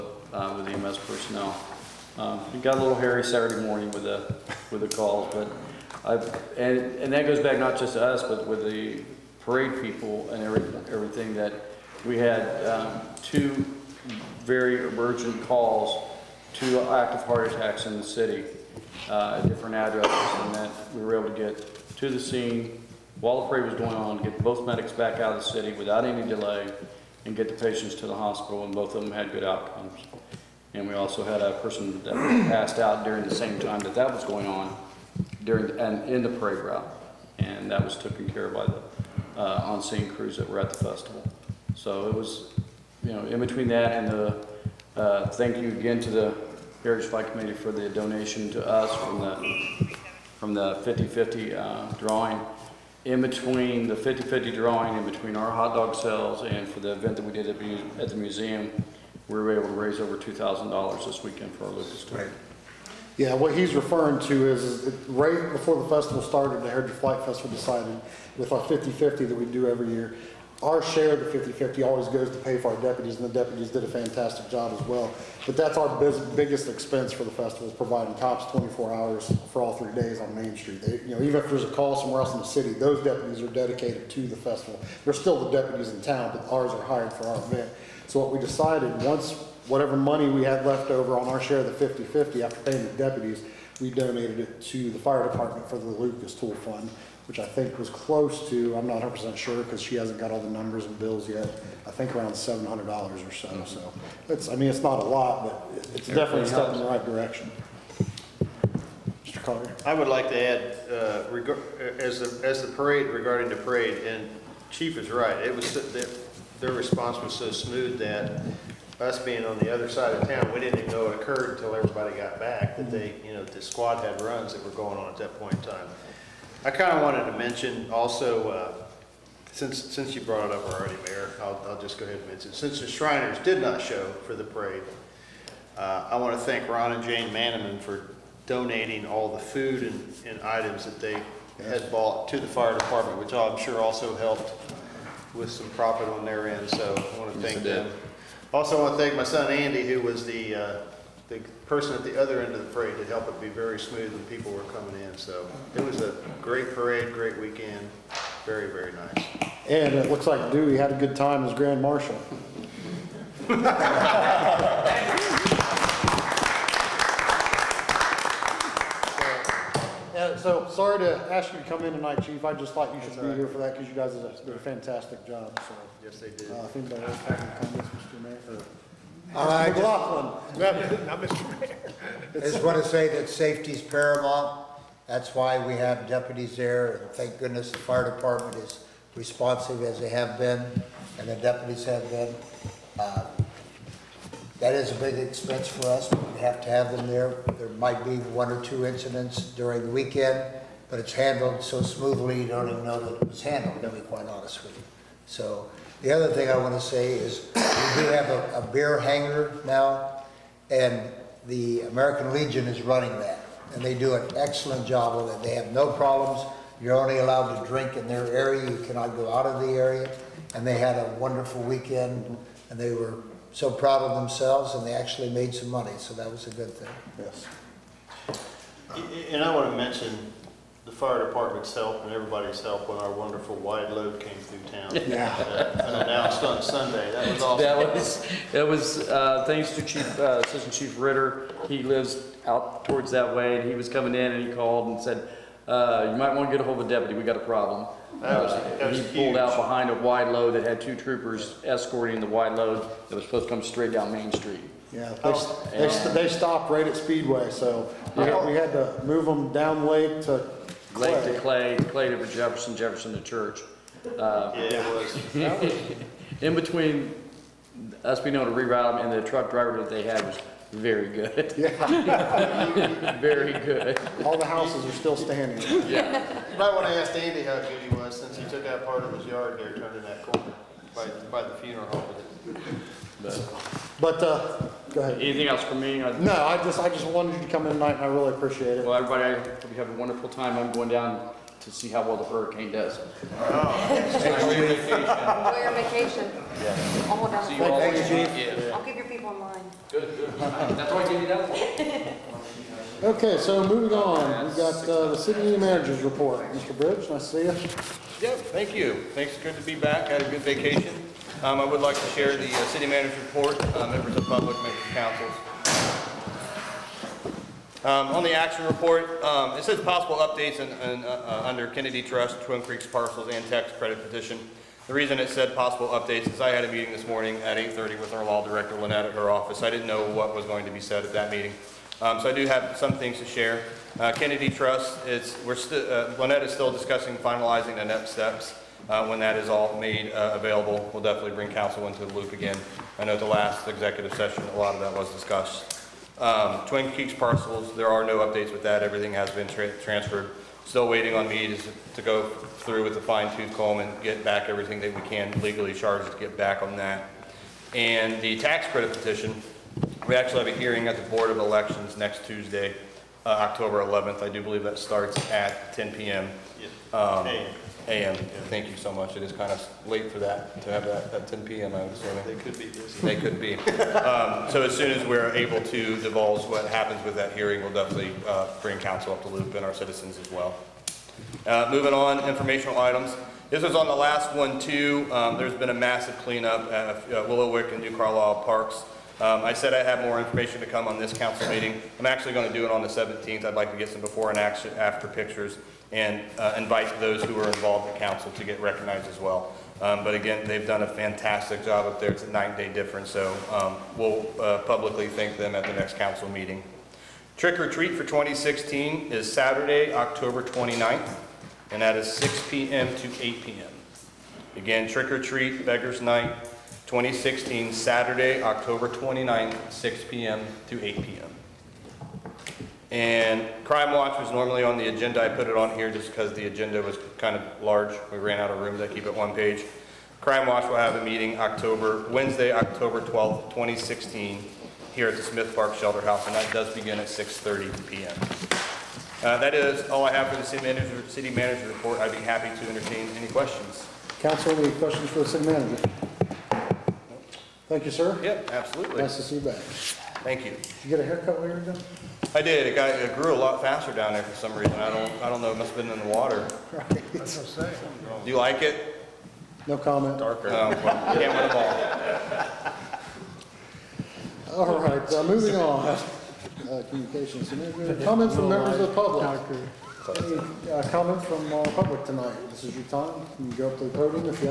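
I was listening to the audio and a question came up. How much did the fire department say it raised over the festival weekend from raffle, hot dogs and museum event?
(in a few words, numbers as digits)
over $2,000.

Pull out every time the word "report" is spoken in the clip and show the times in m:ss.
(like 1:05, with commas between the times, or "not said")
5:06, 5:13, 5:18, 7:21.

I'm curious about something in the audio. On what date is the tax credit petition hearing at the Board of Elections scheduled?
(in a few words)
October 11th.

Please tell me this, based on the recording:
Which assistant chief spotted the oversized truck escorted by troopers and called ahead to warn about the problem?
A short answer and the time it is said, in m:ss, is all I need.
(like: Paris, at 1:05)
Ritter, at 4:00.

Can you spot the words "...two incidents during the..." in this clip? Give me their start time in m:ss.
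3:18.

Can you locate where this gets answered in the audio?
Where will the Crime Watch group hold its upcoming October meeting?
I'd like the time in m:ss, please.
7:15.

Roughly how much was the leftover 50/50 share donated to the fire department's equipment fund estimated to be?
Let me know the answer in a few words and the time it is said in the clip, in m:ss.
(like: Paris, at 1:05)
$700, at 1:42.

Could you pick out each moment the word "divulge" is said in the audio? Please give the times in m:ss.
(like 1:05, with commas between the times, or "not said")
6:16.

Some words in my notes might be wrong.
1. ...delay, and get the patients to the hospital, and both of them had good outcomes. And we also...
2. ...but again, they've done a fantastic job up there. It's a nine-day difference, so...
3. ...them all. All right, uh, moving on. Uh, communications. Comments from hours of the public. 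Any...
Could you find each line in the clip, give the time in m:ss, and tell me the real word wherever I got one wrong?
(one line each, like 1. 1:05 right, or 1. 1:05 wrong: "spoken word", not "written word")
1. 0:26 right
2. 6:40 right
3. 7:41 wrong: "members", not "hours".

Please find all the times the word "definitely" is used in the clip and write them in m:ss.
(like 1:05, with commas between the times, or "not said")
1:46, 5:41, 6:17.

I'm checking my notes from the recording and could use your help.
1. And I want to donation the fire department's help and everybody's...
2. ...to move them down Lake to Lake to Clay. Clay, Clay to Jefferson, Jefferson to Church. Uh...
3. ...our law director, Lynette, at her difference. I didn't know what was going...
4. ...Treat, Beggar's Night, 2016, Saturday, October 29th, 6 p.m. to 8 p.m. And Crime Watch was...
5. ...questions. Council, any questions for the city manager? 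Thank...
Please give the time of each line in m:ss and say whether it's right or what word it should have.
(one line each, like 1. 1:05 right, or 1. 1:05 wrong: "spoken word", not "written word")
1. 3:49 wrong: "mention", not "donation"
2. 4:18 right
3. 5:28 wrong: "office", not "difference"
4. 6:55 right
5. 7:23 right.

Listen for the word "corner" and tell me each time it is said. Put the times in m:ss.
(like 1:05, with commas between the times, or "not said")
4:40.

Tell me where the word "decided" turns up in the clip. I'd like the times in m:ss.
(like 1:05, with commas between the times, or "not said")
1:07, 1:28.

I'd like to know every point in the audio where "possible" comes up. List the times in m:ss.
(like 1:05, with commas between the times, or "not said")
5:19, 5:25.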